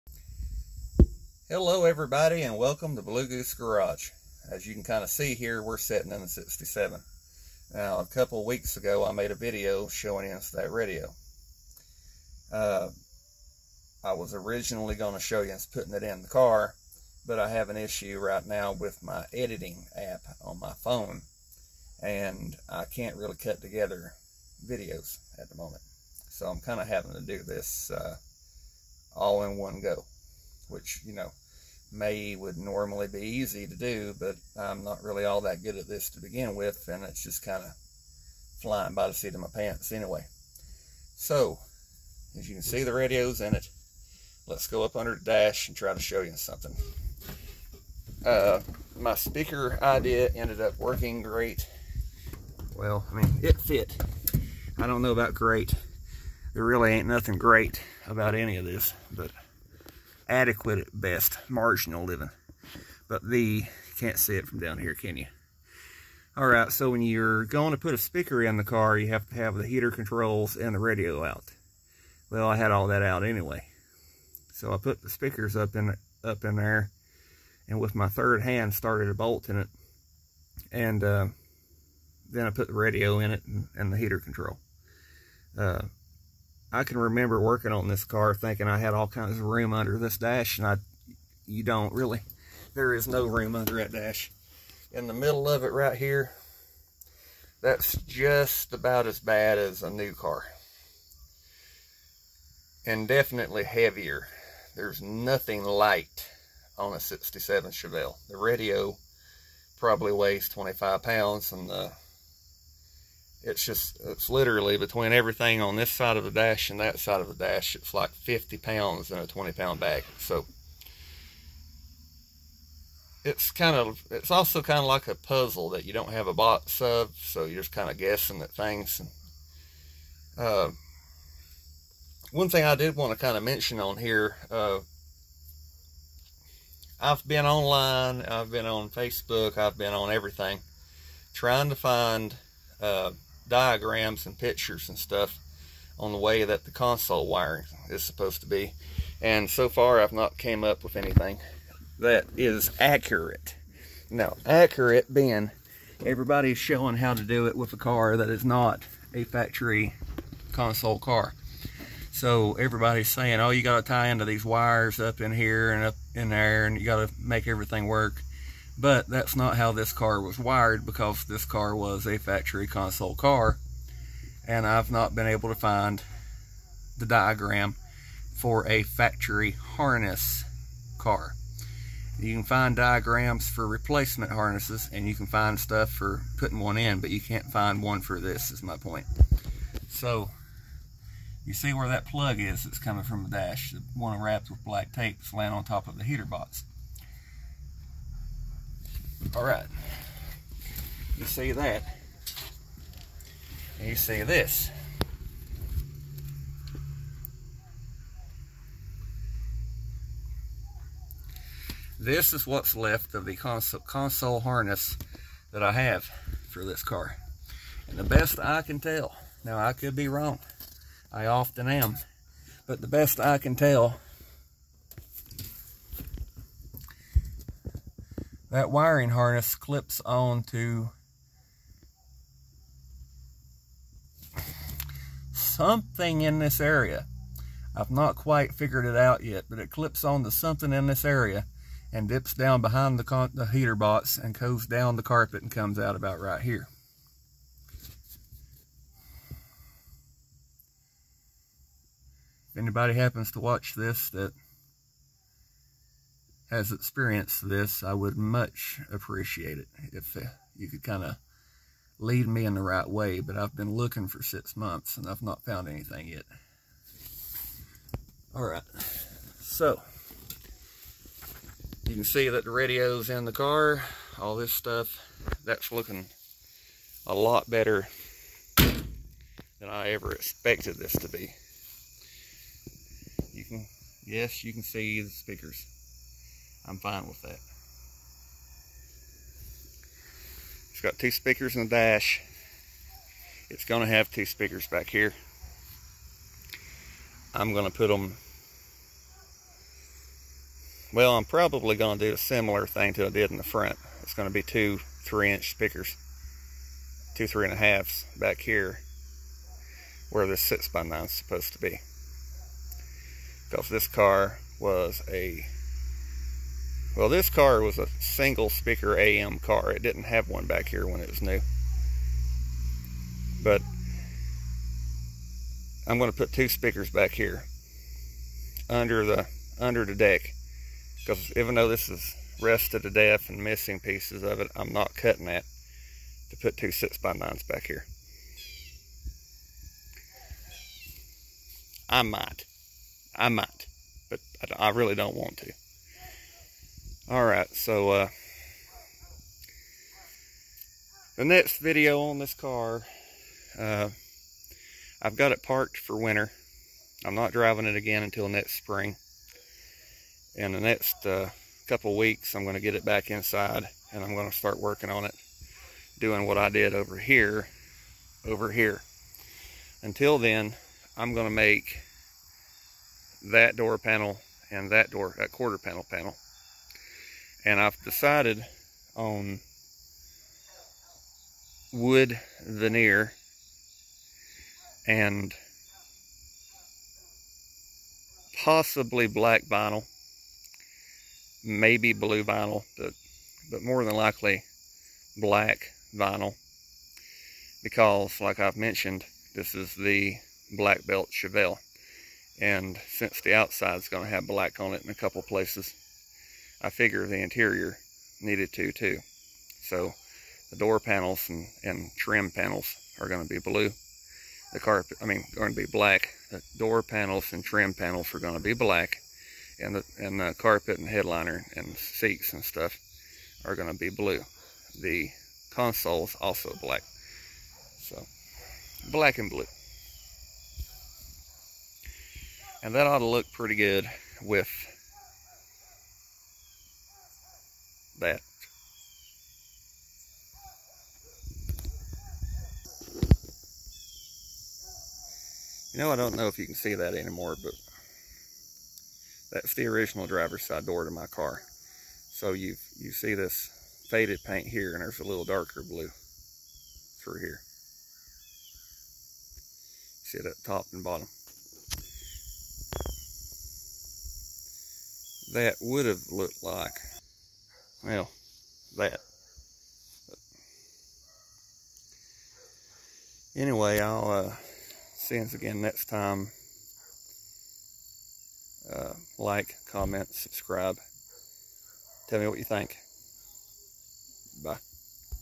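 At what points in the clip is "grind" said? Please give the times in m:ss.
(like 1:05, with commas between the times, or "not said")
not said.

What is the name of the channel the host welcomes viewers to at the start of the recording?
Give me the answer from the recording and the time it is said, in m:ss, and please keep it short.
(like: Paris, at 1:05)
Blue Goose Garage, at 0:03.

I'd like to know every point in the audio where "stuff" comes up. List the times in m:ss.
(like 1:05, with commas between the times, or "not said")
2:24, 3:05, 4:34, 7:02.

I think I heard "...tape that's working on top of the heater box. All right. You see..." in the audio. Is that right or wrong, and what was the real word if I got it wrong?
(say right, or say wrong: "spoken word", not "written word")
wrong: "laying", not "working".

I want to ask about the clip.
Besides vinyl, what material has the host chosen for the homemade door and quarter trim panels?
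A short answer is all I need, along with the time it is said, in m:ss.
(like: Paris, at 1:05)
wood veneer, at 6:21.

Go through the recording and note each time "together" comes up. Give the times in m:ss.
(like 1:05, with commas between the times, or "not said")
0:23.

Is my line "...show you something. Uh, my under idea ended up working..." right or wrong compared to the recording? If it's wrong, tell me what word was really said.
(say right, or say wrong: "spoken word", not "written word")
wrong: "speaker", not "under".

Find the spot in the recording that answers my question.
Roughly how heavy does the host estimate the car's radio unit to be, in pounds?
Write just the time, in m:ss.
1:50.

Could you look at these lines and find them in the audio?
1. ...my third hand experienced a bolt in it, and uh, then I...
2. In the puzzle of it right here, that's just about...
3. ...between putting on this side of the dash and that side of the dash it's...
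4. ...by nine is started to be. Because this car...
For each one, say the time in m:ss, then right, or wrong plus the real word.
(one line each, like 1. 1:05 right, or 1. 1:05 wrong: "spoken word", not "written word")
1. 1:17 wrong: "started", not "experienced"
2. 1:34 wrong: "middle", not "puzzle"
3. 1:54 wrong: "everything", not "putting"
4. 5:10 wrong: "supposed", not "started".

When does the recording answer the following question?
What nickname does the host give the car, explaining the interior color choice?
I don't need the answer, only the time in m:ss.
6:40.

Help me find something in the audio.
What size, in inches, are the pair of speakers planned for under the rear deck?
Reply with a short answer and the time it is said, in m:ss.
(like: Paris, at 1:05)
3.5 inches, at 5:07.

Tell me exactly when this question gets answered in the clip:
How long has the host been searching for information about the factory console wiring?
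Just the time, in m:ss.
4:24.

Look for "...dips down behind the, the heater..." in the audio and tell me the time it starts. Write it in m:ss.
4:02.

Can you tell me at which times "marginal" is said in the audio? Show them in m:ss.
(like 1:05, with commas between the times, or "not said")
1:01.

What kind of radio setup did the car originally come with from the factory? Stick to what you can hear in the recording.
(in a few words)
single speaker AM.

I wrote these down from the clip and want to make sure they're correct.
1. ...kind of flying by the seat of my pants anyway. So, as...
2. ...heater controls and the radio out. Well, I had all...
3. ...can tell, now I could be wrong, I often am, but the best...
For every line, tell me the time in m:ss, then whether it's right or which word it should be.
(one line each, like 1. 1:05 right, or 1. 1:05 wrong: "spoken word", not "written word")
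1. 0:37 right
2. 1:09 right
3. 3:38 right.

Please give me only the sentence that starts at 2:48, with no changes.
But that's not how this car was wired because this car was a factory console car.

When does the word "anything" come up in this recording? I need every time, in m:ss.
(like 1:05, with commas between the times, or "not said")
2:30, 4:25.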